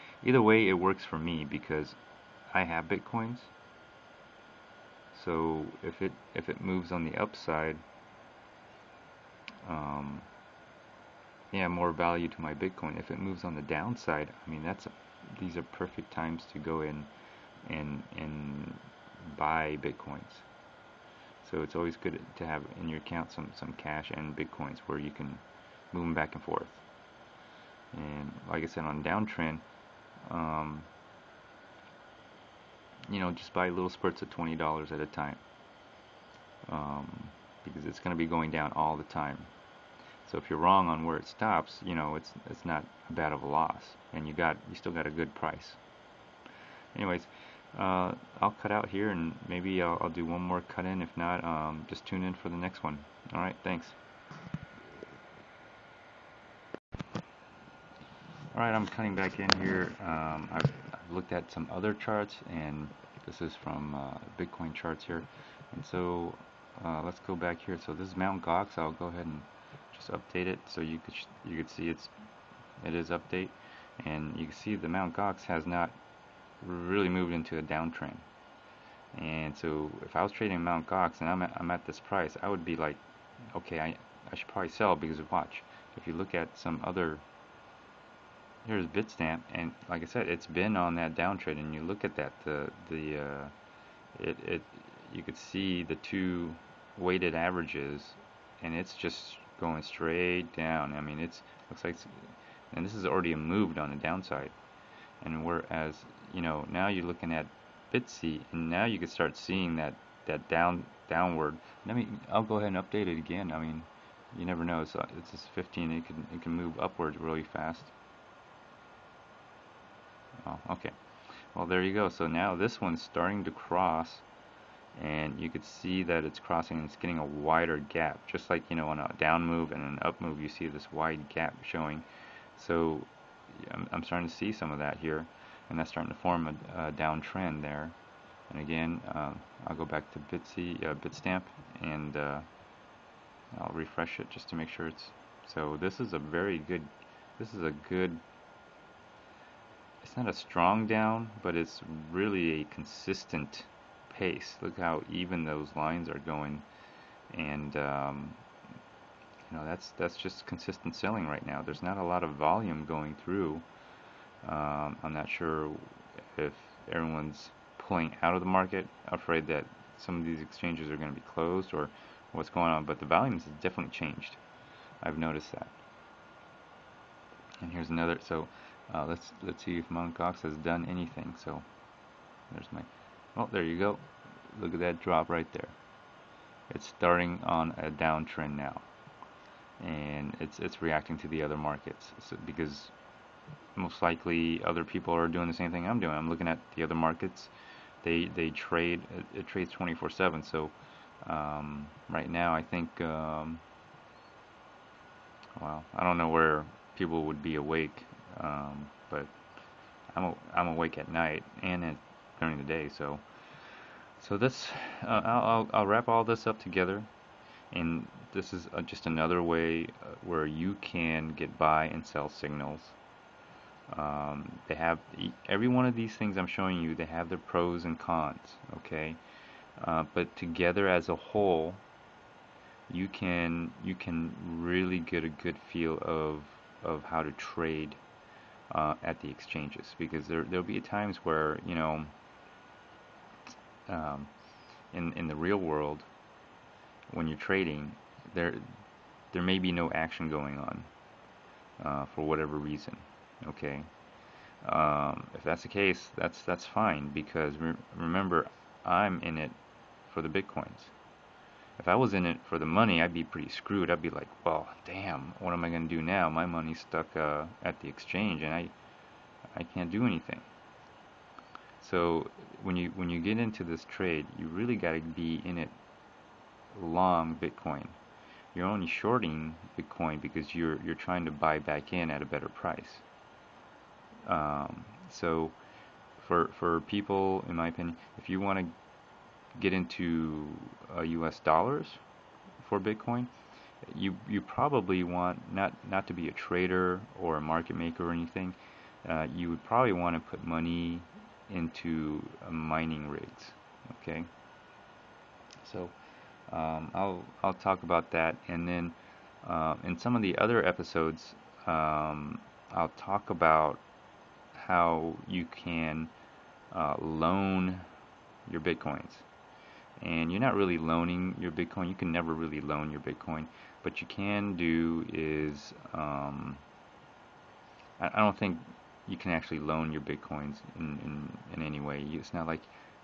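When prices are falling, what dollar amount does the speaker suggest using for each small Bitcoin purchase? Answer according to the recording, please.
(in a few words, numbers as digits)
$20.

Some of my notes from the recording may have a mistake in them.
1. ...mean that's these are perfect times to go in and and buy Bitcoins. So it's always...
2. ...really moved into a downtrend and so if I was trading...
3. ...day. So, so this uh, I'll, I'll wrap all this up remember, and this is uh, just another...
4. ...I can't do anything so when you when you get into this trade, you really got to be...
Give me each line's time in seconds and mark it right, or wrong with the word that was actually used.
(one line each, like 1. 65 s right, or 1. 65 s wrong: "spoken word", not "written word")
1. 14 s right
2. 76 s right
3. 212 s wrong: "together", not "remember"
4. 269 s right.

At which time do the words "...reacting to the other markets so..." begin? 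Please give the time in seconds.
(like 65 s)
190 s.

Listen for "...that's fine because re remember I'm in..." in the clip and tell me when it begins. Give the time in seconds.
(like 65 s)
256 s.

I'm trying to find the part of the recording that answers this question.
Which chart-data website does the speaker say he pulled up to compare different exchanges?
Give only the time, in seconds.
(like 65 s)
64 s.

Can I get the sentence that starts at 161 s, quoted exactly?
There's not a lot of volume going through.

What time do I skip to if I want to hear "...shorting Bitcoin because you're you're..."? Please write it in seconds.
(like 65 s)
278 s.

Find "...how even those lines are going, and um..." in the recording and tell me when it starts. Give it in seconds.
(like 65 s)
154 s.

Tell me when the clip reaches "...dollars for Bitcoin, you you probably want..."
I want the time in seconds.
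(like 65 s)
291 s.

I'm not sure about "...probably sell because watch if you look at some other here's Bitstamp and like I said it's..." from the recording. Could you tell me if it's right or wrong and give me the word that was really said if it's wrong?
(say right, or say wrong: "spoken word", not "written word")
right.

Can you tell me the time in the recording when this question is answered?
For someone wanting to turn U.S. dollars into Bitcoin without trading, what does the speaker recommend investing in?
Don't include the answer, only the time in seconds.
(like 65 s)
302 s.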